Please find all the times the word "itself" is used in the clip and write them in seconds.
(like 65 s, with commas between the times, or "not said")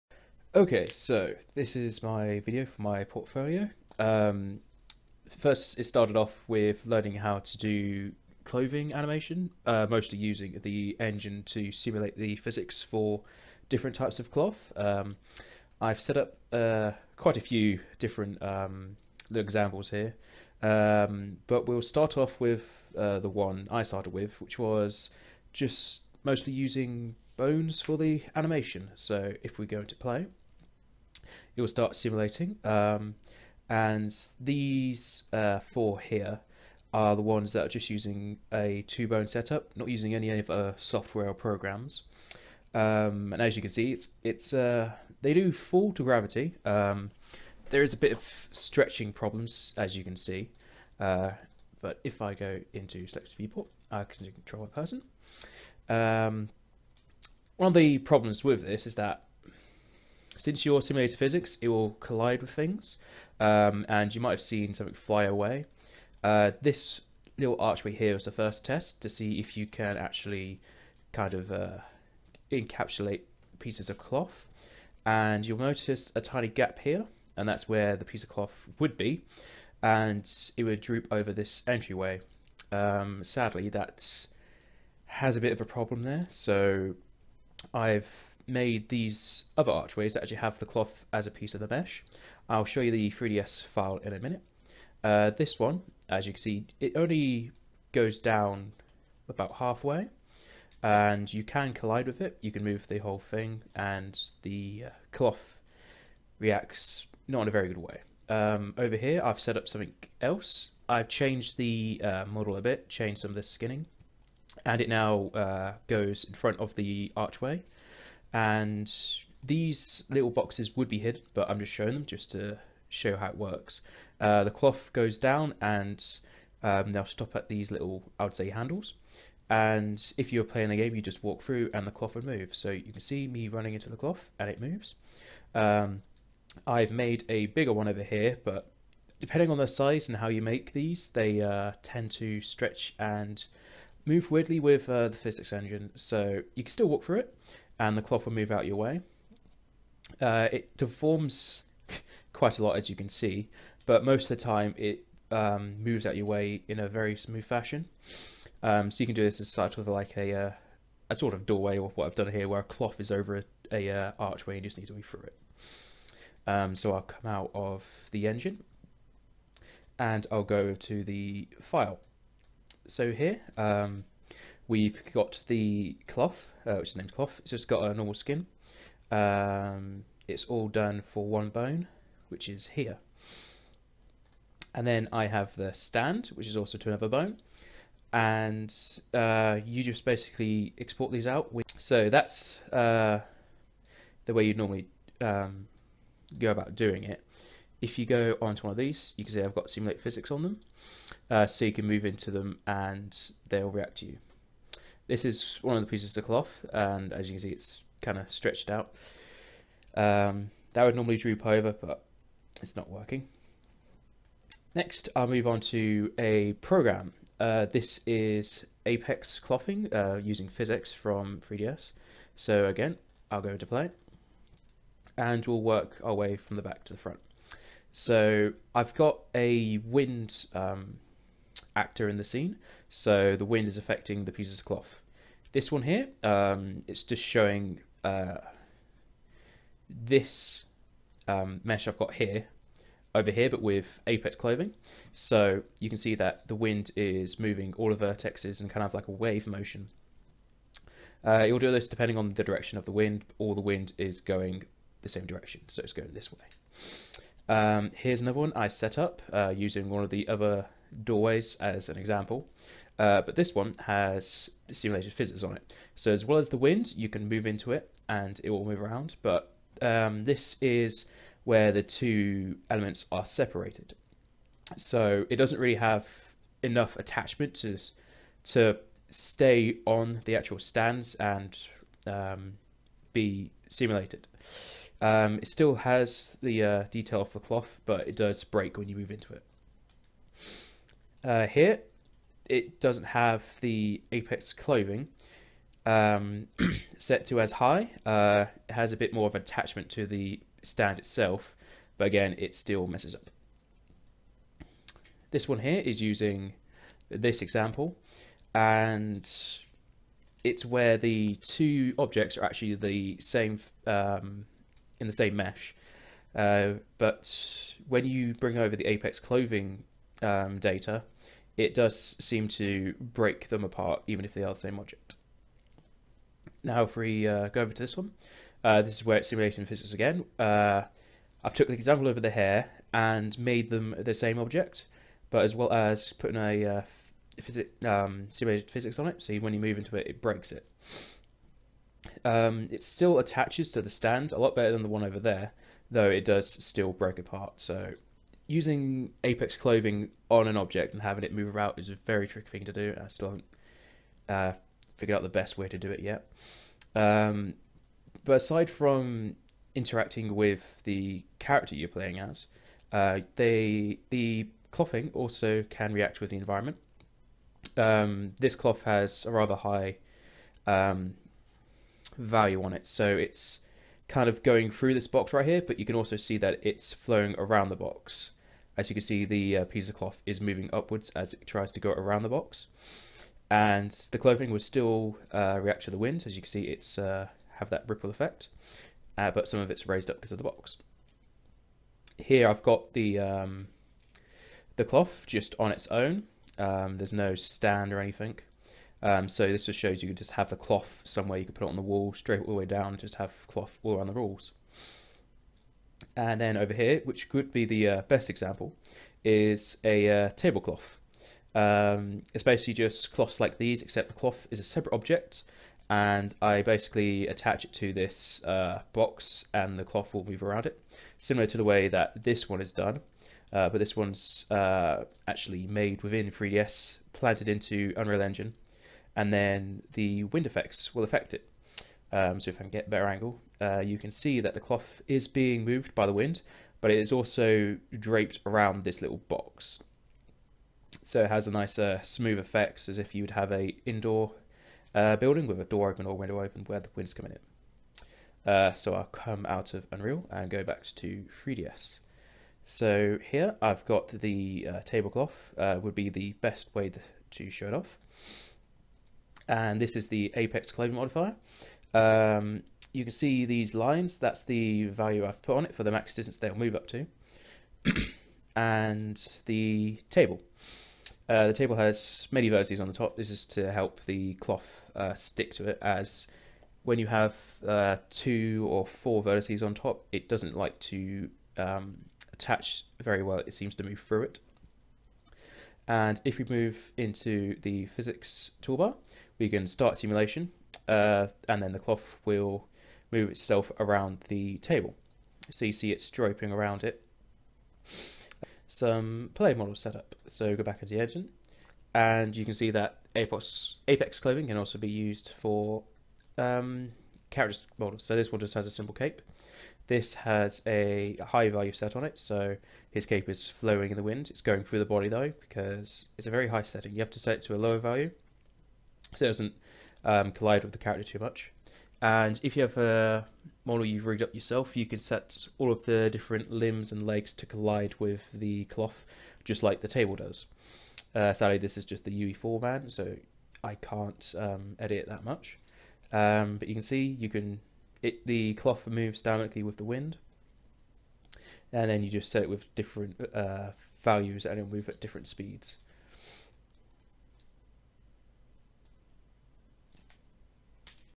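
300 s, 493 s.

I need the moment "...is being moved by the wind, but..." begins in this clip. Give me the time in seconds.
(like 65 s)
435 s.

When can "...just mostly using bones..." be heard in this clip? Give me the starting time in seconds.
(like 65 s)
25 s.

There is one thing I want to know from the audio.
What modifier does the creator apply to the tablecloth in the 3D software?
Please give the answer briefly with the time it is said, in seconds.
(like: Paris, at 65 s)
apex claim modifier, at 460 s.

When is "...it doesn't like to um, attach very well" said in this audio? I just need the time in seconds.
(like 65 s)
480 s.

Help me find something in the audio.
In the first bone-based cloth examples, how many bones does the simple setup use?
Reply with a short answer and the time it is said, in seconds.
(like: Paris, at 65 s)
2, at 38 s.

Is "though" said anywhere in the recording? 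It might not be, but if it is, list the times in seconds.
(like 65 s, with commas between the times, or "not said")
345 s, 515 s.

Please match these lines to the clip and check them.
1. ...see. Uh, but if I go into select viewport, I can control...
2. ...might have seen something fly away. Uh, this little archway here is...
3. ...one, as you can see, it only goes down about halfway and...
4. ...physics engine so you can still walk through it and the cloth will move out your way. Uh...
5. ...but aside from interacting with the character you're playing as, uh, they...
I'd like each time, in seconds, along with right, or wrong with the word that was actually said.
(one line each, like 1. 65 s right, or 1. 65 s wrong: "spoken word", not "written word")
1. 50 s right
2. 64 s right
3. 95 s right
4. 145 s right
5. 358 s right.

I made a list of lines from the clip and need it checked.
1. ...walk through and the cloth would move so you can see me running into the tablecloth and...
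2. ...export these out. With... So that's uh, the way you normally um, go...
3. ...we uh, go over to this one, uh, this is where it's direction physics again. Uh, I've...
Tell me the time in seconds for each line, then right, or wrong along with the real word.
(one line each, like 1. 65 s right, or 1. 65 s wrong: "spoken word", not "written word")
1. 131 s wrong: "cloth", not "tablecloth"
2. 190 s right
3. 326 s wrong: "simulation", not "direction".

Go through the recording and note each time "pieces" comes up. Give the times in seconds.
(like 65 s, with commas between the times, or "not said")
73 s, 78 s, 91 s, 205 s, 234 s, 379 s.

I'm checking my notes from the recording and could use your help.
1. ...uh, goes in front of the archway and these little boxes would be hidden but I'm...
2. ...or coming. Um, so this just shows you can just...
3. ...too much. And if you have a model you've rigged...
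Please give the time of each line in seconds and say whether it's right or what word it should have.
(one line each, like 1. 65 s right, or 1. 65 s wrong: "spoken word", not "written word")
1. 115 s right
2. 397 s wrong: "anything", not "coming"
3. 521 s right.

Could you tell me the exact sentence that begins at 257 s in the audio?
Um, here's another one I set up uh, using one of the other doorways as an example.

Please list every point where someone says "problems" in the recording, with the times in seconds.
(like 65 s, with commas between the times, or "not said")
49 s, 57 s, 85 s.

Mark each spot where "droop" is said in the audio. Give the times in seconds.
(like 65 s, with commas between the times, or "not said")
80 s, 211 s.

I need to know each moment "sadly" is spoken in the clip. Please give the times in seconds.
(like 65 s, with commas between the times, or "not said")
83 s, 531 s.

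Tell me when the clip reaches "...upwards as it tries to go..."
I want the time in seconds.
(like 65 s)
380 s.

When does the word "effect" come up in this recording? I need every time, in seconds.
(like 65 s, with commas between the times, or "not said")
388 s, 430 s, 442 s.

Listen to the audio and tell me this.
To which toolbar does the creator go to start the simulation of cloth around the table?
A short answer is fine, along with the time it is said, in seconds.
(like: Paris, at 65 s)
physics toolbar, at 487 s.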